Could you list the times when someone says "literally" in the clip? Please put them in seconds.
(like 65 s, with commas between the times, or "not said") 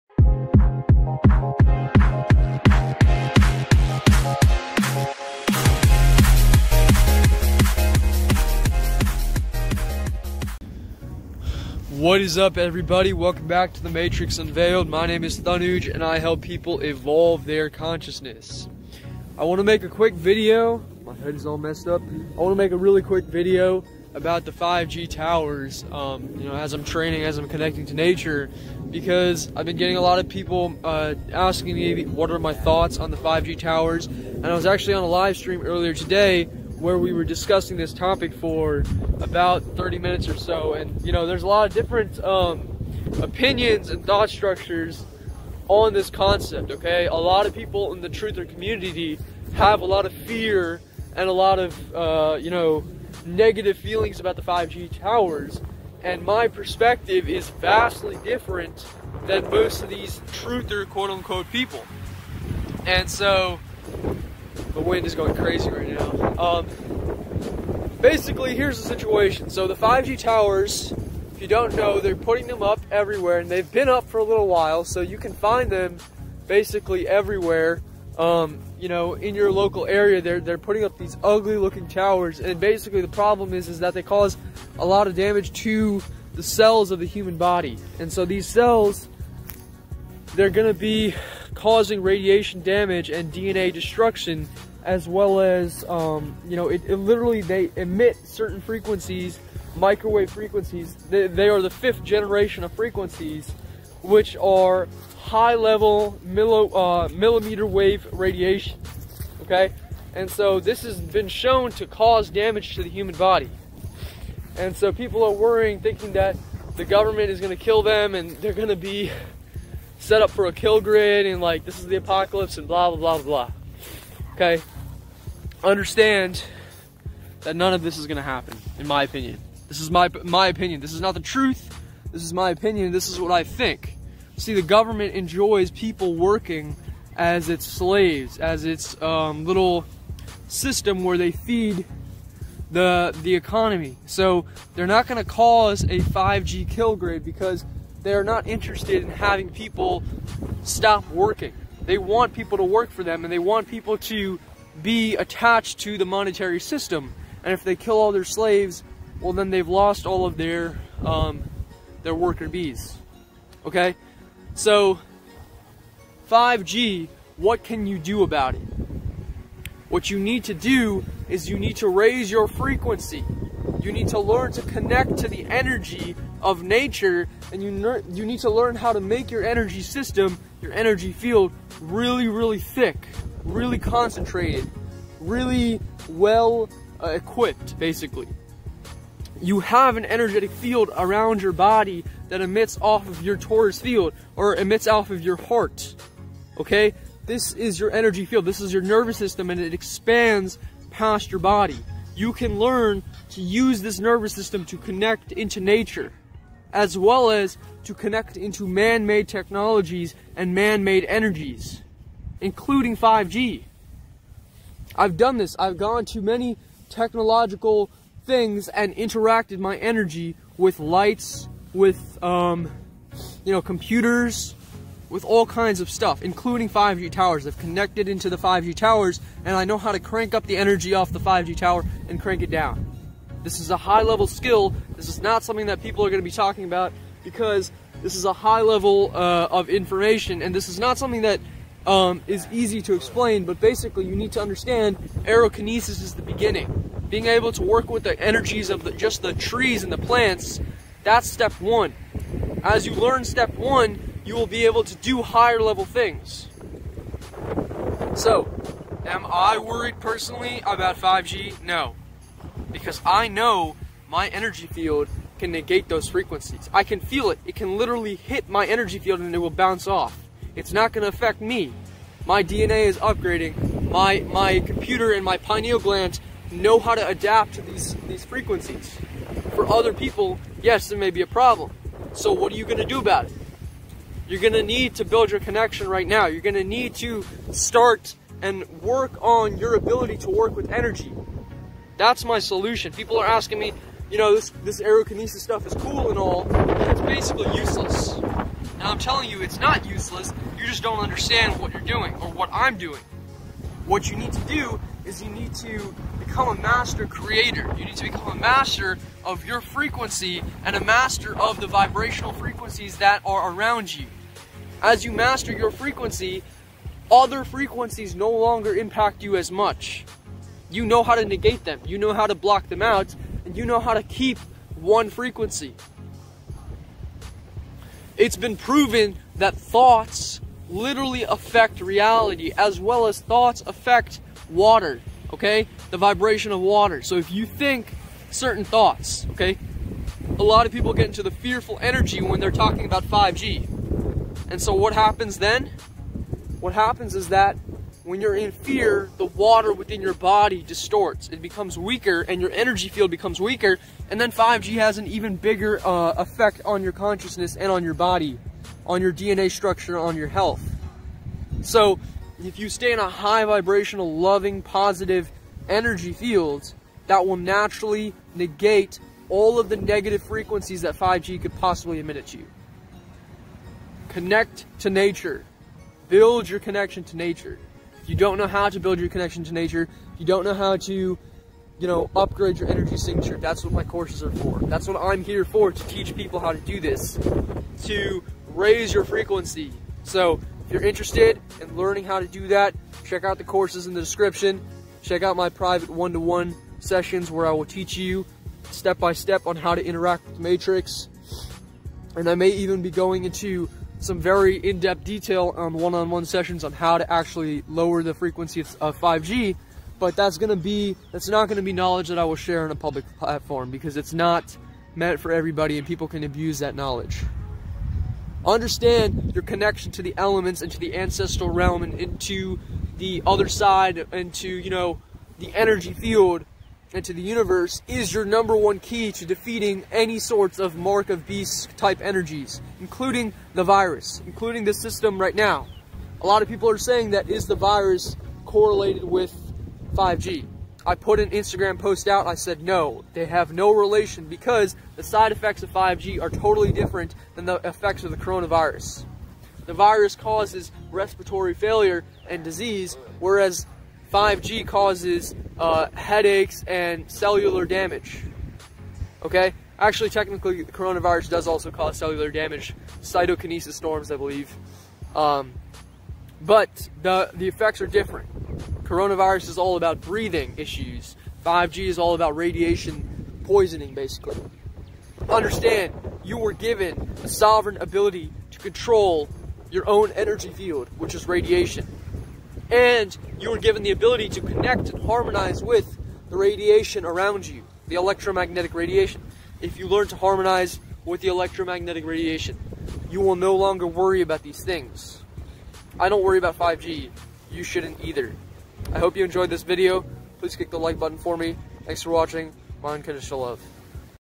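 96 s, 267 s, 330 s.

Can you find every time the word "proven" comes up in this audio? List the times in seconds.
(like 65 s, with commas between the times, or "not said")
328 s.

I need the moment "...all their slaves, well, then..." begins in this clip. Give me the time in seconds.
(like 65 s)
157 s.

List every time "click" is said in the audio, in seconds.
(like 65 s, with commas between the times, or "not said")
500 s.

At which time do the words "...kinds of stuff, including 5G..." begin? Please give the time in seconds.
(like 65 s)
225 s.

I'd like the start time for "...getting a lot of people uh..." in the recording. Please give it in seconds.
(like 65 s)
29 s.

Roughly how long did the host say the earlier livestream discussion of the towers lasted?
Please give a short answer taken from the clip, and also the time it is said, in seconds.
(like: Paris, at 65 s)
30 minutes, at 39 s.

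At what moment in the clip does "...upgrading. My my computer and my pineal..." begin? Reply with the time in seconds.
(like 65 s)
272 s.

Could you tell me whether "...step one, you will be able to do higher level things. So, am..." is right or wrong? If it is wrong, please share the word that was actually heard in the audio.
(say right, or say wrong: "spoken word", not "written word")
right.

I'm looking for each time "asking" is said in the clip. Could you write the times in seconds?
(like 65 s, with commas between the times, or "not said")
31 s, 293 s.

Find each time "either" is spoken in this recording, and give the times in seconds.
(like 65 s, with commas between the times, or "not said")
498 s.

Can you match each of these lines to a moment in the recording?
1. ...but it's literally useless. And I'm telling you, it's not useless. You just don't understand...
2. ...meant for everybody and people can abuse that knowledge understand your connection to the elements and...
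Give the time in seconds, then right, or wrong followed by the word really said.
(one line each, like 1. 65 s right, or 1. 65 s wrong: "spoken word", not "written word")
1. 296 s wrong: "basically", not "literally"
2. 414 s right.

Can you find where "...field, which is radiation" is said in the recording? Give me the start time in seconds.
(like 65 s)
480 s.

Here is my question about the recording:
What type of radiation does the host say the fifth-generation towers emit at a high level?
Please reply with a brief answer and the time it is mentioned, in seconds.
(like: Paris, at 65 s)
Millimeter wave radiation, at 107 s.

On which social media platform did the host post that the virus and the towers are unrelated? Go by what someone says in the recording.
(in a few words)
Instagram.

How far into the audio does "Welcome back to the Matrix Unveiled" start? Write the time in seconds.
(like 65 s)
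13 s.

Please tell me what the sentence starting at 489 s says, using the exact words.
If you learn to harmonize with the electromagnetic radiation, you will no longer worry about these things.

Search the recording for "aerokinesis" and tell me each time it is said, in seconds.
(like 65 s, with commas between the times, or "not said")
245 s, 294 s.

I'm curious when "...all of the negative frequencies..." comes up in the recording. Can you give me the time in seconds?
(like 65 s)
369 s.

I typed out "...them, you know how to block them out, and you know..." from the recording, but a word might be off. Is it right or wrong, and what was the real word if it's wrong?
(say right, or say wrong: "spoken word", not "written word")
right.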